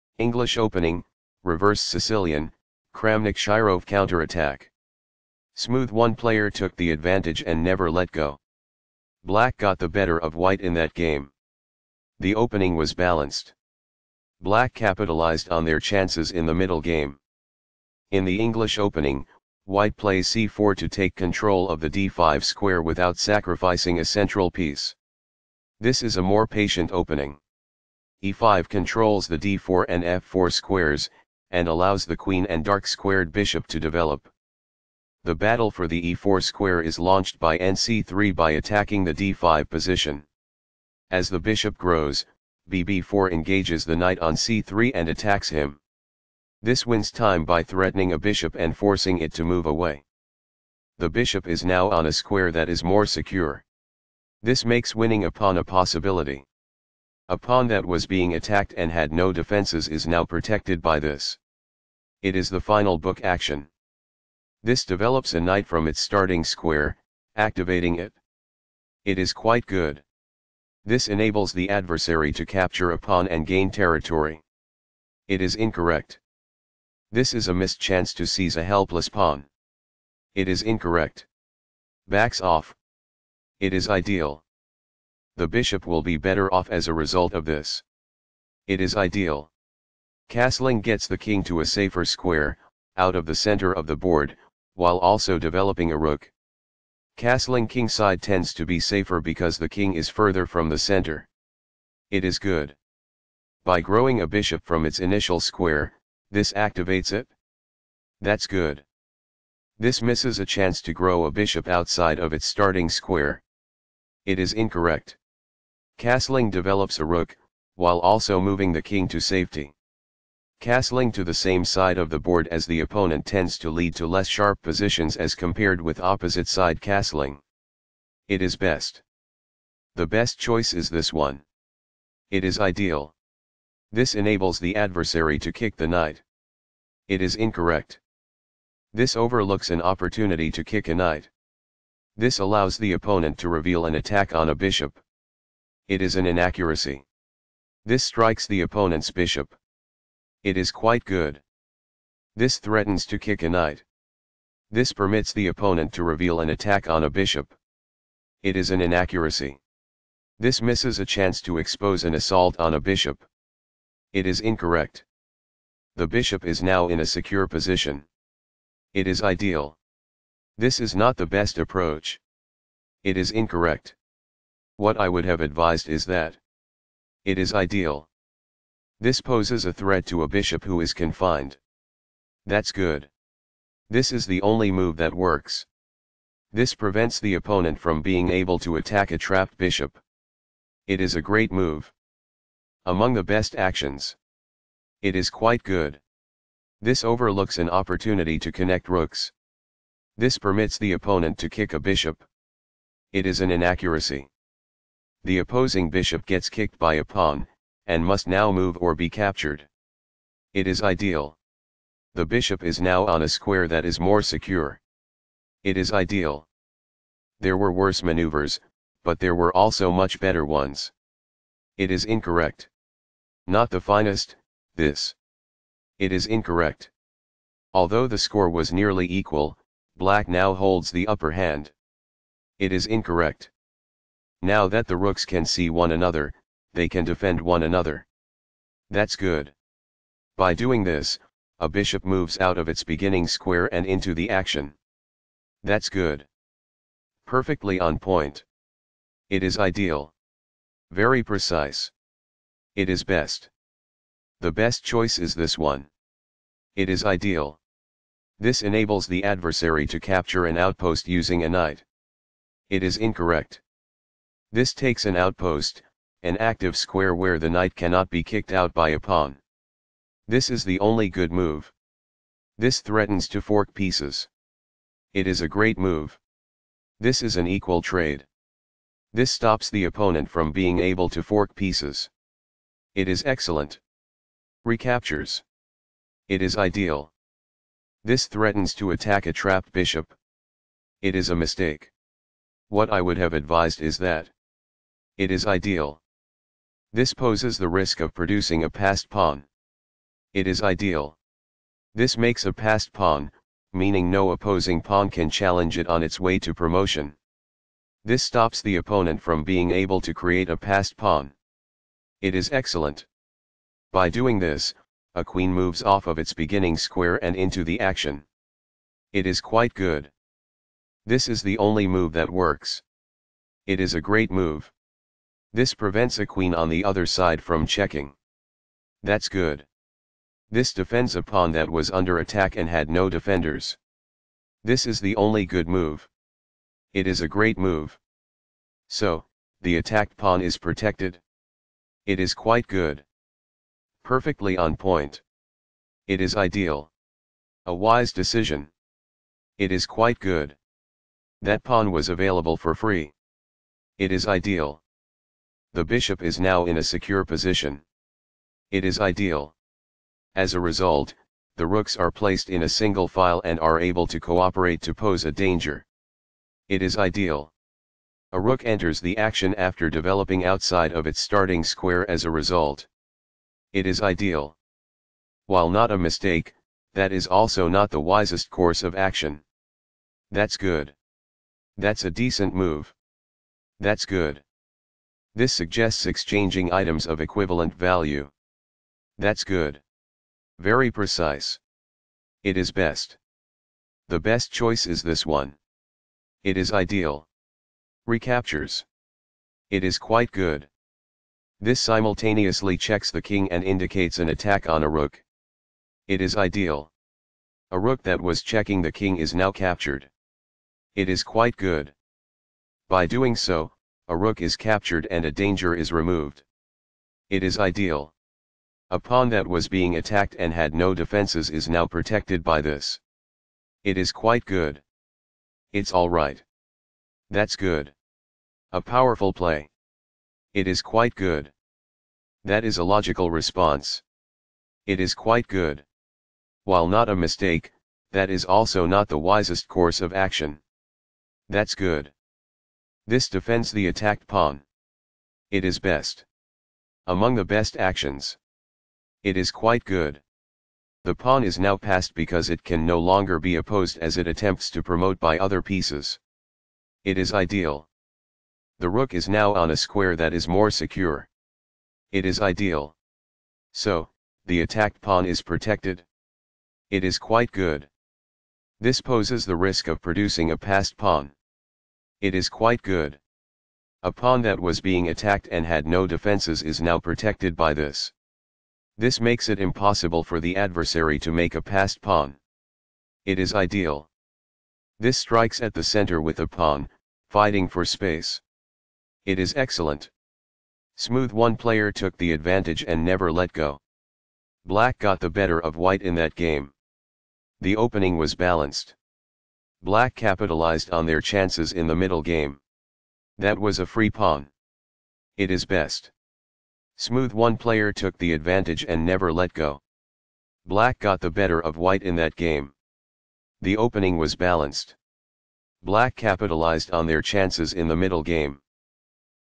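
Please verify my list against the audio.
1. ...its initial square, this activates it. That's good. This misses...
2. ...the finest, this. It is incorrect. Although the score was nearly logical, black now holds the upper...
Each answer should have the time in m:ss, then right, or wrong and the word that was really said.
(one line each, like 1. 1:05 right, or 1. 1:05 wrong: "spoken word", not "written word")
1. 1:44 right
2. 3:43 wrong: "equal", not "logical".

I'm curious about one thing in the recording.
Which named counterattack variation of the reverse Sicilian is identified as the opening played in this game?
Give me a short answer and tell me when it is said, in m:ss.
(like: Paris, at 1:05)
Kramnik Shirov counterattack, at 0:02.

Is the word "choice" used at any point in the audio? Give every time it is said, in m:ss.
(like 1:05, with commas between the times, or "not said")
2:10, 4:14, 6:34.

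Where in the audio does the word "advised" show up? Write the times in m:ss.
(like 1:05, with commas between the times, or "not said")
2:55, 4:53.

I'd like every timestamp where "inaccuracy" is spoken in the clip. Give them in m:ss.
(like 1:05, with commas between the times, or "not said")
2:26, 2:38, 3:23.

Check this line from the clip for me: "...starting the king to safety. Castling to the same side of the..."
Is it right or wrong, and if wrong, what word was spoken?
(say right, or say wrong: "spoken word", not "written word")
wrong: "moving", not "starting".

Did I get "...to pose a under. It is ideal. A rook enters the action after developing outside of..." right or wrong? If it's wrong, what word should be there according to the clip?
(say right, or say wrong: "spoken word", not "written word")
wrong: "danger", not "under".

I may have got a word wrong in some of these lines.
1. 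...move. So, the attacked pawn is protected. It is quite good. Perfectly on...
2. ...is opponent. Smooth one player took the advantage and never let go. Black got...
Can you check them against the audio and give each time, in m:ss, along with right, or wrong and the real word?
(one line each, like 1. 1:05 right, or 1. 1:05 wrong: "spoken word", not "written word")
1. 5:37 right
2. 8:09 wrong: "excellent", not "opponent".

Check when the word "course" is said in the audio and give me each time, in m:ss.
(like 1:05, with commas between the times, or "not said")
6:18, 7:19.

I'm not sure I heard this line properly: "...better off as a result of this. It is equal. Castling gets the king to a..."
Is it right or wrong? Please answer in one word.
wrong.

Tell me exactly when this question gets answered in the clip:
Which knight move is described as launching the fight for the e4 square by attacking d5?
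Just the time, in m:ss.
0:37.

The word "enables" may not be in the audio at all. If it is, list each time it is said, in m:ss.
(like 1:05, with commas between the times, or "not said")
1:11, 2:14, 4:18.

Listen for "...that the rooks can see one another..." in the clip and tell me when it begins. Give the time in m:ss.
3:54.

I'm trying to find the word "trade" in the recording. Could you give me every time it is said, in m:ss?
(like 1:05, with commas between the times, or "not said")
4:37.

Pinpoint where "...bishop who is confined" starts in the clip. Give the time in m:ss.
3:00.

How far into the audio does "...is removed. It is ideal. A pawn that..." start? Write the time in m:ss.
6:55.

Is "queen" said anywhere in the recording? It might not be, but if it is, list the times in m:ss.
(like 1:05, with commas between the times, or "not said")
0:32, 5:15, 5:26.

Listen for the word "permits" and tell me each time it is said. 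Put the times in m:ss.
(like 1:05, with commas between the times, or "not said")
2:34, 3:20.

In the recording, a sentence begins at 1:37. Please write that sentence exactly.
Castling kingside tends to be safer because the king is further from the center.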